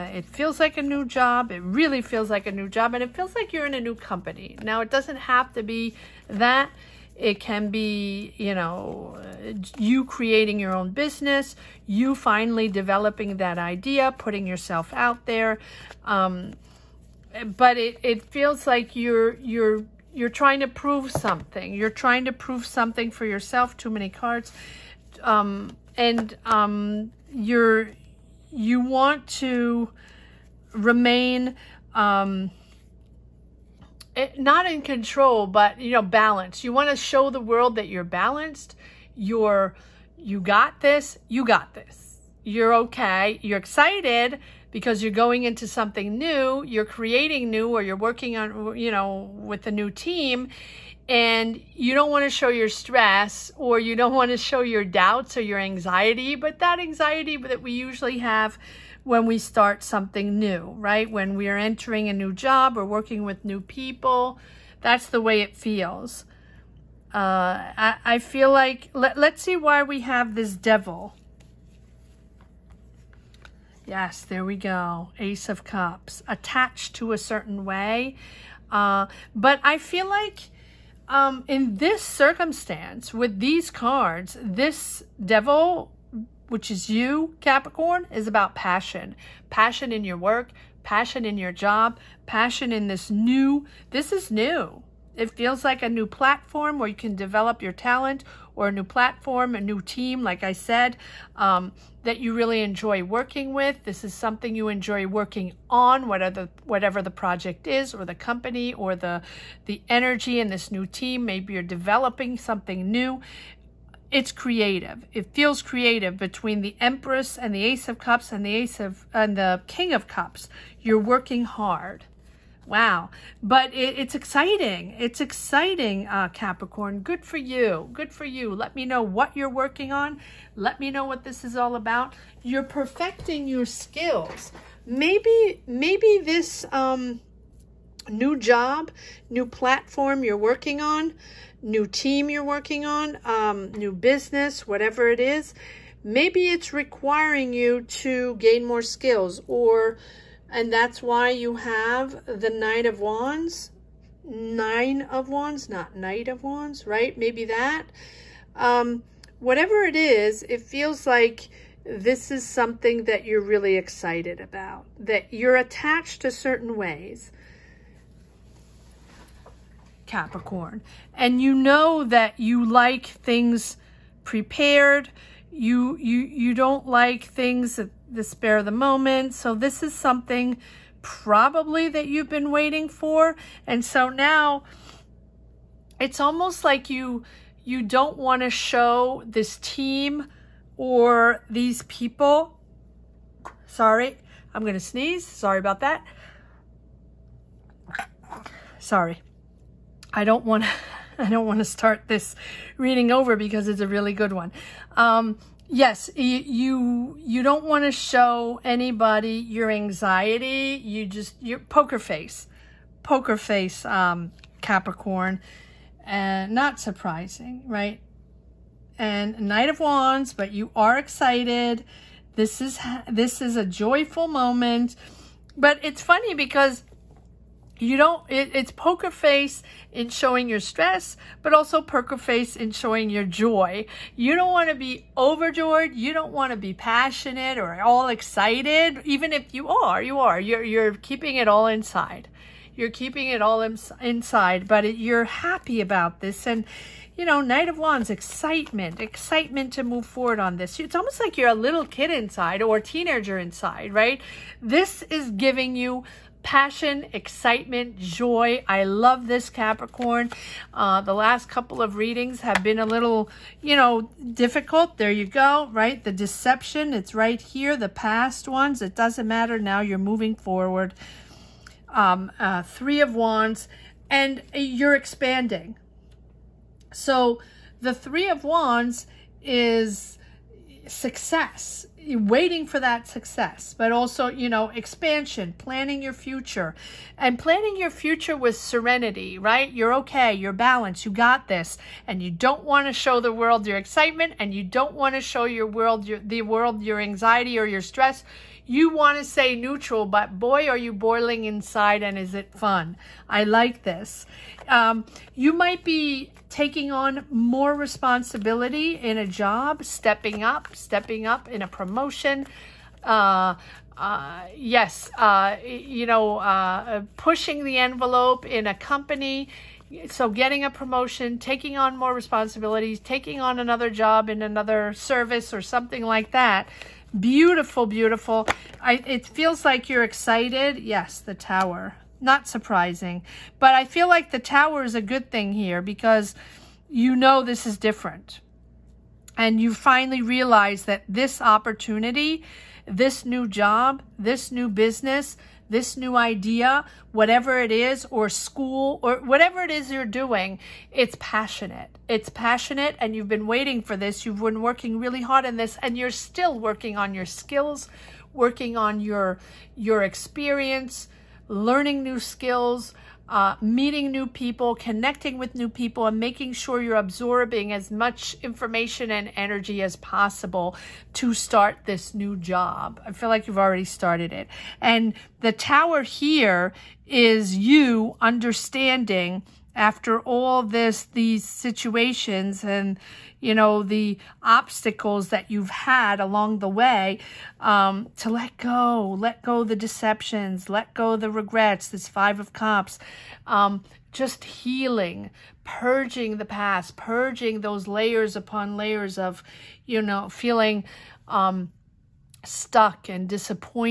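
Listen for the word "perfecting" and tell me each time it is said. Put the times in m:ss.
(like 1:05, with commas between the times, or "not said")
2:12.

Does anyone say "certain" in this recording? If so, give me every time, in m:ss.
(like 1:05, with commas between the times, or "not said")
1:17, 2:46.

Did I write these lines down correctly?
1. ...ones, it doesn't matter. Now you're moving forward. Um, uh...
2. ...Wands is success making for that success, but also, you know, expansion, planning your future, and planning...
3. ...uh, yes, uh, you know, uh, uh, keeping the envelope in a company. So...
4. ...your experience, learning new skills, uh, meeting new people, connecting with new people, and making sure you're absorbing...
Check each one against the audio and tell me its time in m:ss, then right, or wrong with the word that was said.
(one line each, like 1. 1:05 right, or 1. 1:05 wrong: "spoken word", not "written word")
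1. 4:28 right
2. 4:38 wrong: "waiting", not "making"
3. 5:13 wrong: "pushing", not "keeping"
4. 5:59 right.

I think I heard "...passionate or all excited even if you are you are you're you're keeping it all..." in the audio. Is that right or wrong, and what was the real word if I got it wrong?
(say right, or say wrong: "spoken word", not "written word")
right.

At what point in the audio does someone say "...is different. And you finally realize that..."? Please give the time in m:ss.
5:37.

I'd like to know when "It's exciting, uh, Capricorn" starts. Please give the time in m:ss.
2:04.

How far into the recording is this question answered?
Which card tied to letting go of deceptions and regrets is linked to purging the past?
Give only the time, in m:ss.
6:32.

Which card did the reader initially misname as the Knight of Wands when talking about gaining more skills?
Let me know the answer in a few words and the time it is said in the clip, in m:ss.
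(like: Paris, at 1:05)
Nine of Wands, at 2:34.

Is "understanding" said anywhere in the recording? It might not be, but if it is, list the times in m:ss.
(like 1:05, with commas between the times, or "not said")
6:18.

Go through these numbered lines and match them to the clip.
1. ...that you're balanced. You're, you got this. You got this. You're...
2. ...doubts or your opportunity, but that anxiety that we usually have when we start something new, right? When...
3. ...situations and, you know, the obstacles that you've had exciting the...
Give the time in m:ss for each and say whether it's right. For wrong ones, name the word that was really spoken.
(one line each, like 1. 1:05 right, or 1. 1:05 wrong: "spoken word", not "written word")
1. 0:37 right
2. 0:54 wrong: "anxiety", not "opportunity"
3. 6:21 wrong: "along", not "exciting".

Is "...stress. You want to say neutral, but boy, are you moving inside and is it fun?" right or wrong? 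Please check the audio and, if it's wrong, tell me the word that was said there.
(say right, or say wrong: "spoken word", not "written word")
wrong: "boiling", not "moving".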